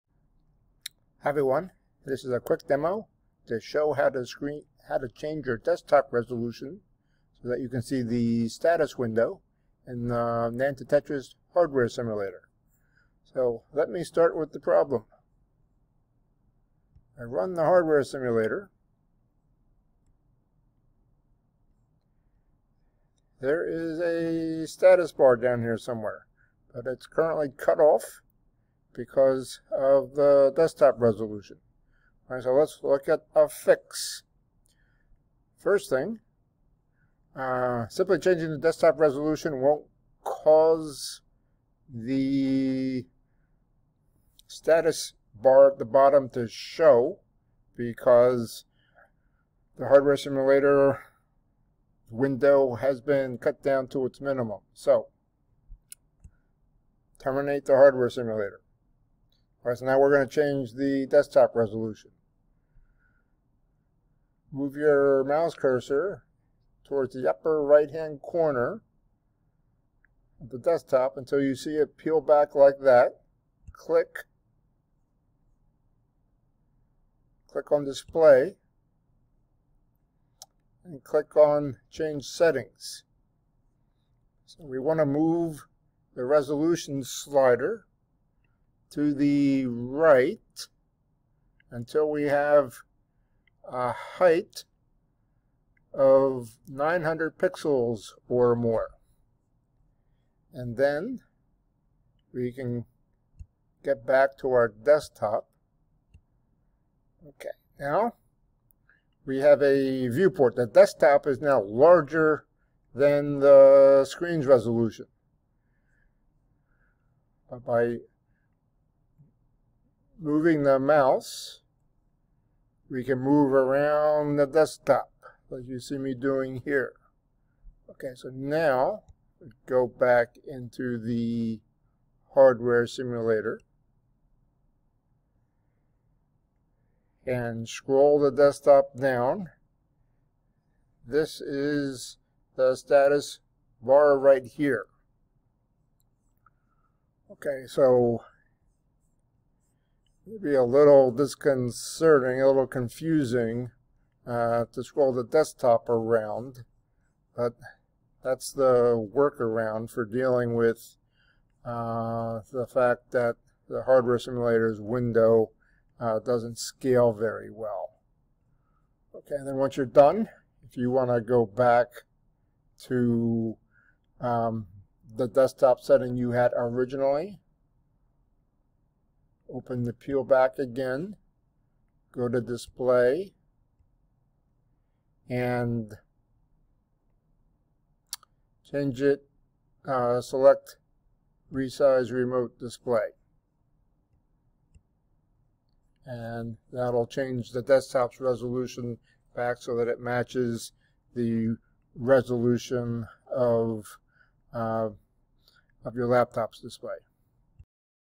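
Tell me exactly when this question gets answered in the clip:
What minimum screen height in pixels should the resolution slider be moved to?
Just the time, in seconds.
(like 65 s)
96 s.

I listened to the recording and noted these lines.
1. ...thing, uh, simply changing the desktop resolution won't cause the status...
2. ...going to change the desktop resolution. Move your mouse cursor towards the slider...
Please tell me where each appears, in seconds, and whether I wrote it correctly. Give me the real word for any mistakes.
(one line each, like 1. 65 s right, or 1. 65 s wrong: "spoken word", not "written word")
1. 35 s right
2. 60 s wrong: "upper", not "slider".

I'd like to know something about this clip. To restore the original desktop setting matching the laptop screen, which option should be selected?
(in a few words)
resize remote display.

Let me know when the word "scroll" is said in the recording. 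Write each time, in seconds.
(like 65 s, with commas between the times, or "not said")
137 s, 154 s.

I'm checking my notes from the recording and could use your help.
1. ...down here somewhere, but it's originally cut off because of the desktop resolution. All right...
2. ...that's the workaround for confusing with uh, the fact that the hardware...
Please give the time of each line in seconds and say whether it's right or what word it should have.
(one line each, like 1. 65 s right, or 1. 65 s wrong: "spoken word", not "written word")
1. 25 s wrong: "currently", not "originally"
2. 158 s wrong: "dealing", not "confusing".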